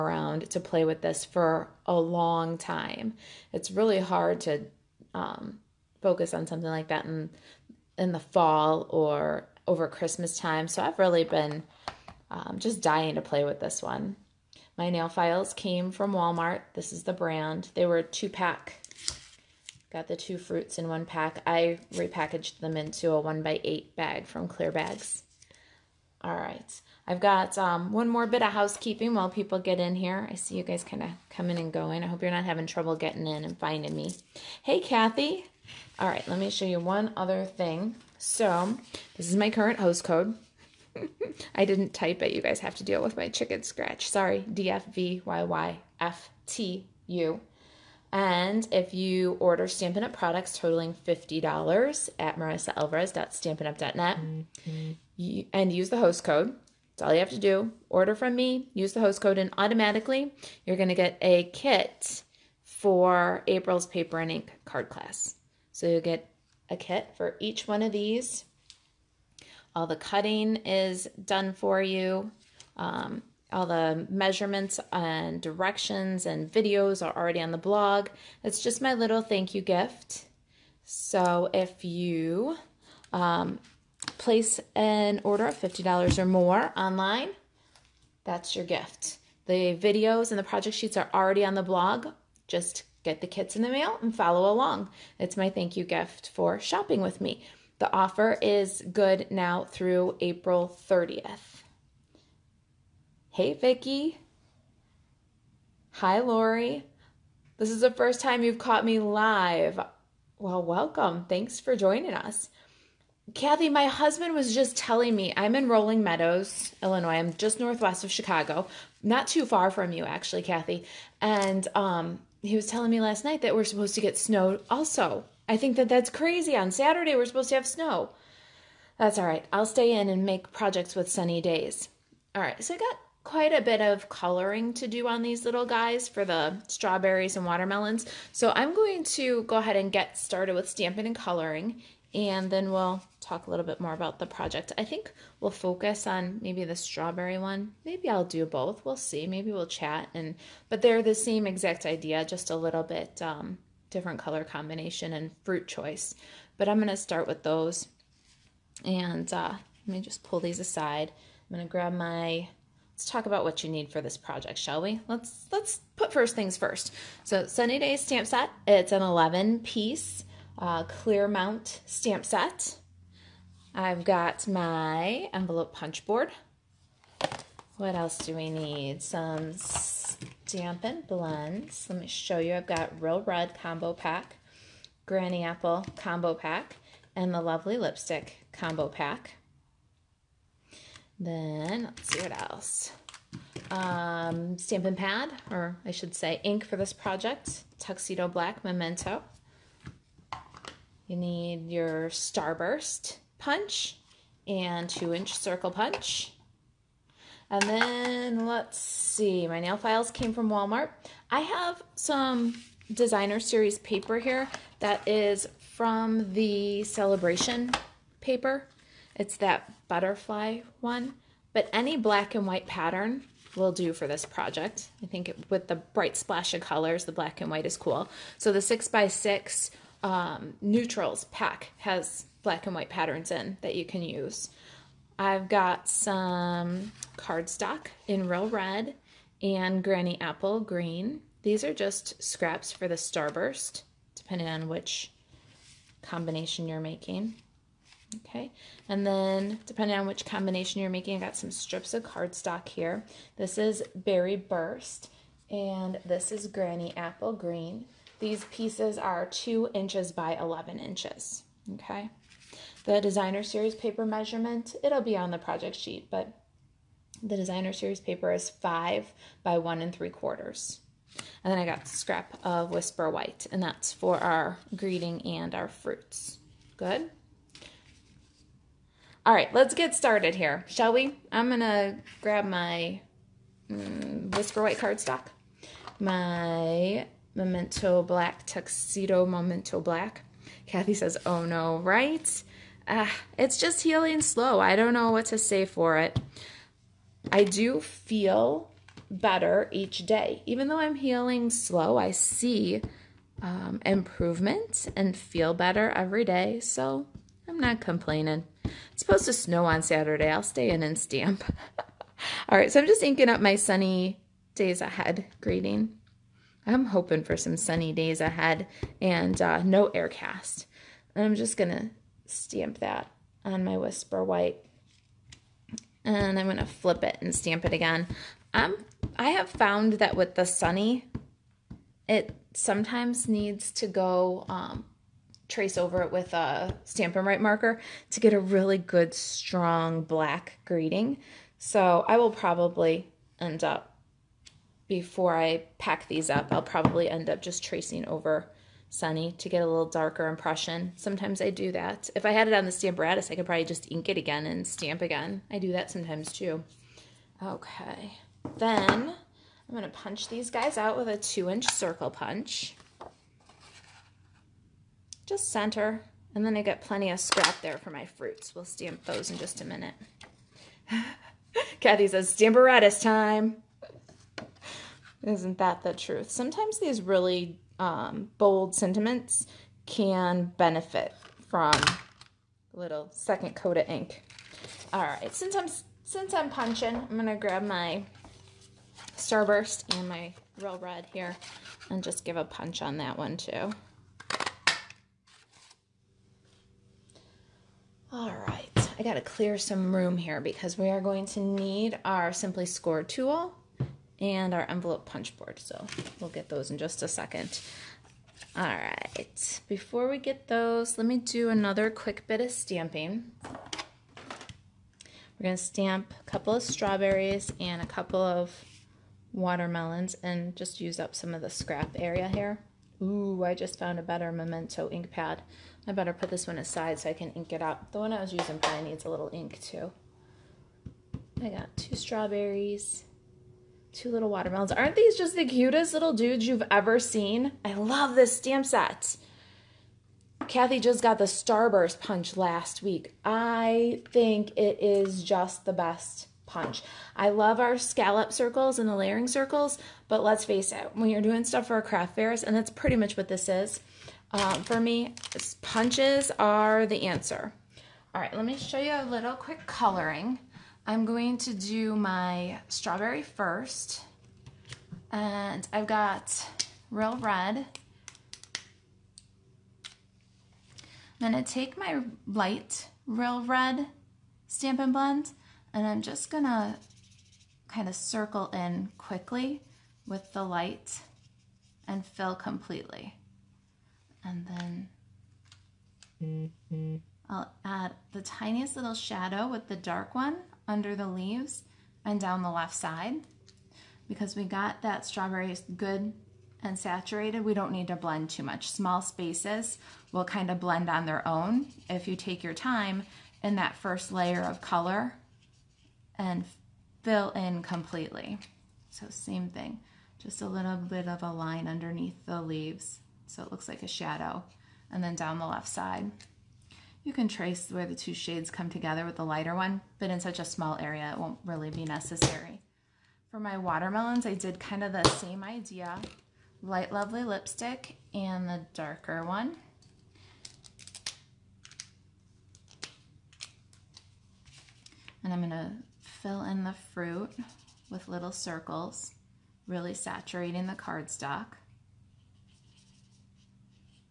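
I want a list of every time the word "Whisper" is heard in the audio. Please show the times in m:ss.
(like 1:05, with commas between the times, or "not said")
4:32, 4:44, 5:23.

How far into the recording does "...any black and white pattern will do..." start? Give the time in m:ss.
3:41.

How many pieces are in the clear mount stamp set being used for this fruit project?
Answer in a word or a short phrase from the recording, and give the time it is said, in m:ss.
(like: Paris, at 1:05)
11, at 2:49.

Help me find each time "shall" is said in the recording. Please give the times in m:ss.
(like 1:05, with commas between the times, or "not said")
2:44, 4:40.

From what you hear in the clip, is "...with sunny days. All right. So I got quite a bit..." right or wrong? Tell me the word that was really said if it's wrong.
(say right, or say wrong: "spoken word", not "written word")
right.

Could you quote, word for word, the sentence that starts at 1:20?
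So if you um, place an order of $50 or more online, that's your gift.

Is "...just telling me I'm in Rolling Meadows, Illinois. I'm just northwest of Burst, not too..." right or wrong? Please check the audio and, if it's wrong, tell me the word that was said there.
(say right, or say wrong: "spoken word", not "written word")
wrong: "Chicago", not "Burst".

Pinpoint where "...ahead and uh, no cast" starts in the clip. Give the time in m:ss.
5:18.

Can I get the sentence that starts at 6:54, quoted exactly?
We're gonna stamp a couple of strawberries and a couple of watermelons and just use up some of the scrap area here.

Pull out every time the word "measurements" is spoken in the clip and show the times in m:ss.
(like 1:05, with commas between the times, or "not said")
1:14, 4:24.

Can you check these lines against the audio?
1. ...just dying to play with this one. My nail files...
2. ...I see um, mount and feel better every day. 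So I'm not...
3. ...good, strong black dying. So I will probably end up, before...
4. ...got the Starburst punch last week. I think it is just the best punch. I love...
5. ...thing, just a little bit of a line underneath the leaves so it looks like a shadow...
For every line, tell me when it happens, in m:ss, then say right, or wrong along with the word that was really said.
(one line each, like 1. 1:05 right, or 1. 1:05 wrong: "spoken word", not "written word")
1. 0:12 right
2. 5:01 wrong: "improvement", not "mount"
3. 5:38 wrong: "greeting", not "dying"
4. 7:21 right
5. 8:29 right.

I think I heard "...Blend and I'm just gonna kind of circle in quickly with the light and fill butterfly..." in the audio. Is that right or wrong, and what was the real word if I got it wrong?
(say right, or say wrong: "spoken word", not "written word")
wrong: "completely", not "butterfly".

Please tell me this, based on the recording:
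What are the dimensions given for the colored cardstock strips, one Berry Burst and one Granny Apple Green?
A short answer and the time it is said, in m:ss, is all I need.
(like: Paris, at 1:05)
2 by 11 inches, at 4:19.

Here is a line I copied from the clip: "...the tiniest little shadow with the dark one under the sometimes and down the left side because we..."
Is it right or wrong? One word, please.
wrong.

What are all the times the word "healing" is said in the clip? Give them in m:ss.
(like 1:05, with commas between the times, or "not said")
4:53, 5:00.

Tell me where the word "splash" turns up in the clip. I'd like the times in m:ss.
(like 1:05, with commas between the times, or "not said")
3:46.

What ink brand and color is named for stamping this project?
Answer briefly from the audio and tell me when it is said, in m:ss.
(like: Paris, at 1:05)
Tuxedo Black Memento, at 3:17.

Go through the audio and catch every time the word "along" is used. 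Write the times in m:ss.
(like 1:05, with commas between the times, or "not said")
1:34.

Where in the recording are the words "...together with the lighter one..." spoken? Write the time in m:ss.
8:38.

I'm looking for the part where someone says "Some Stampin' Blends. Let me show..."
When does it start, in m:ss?
2:59.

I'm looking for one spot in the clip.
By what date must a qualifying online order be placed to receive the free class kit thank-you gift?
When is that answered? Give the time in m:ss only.
1:40.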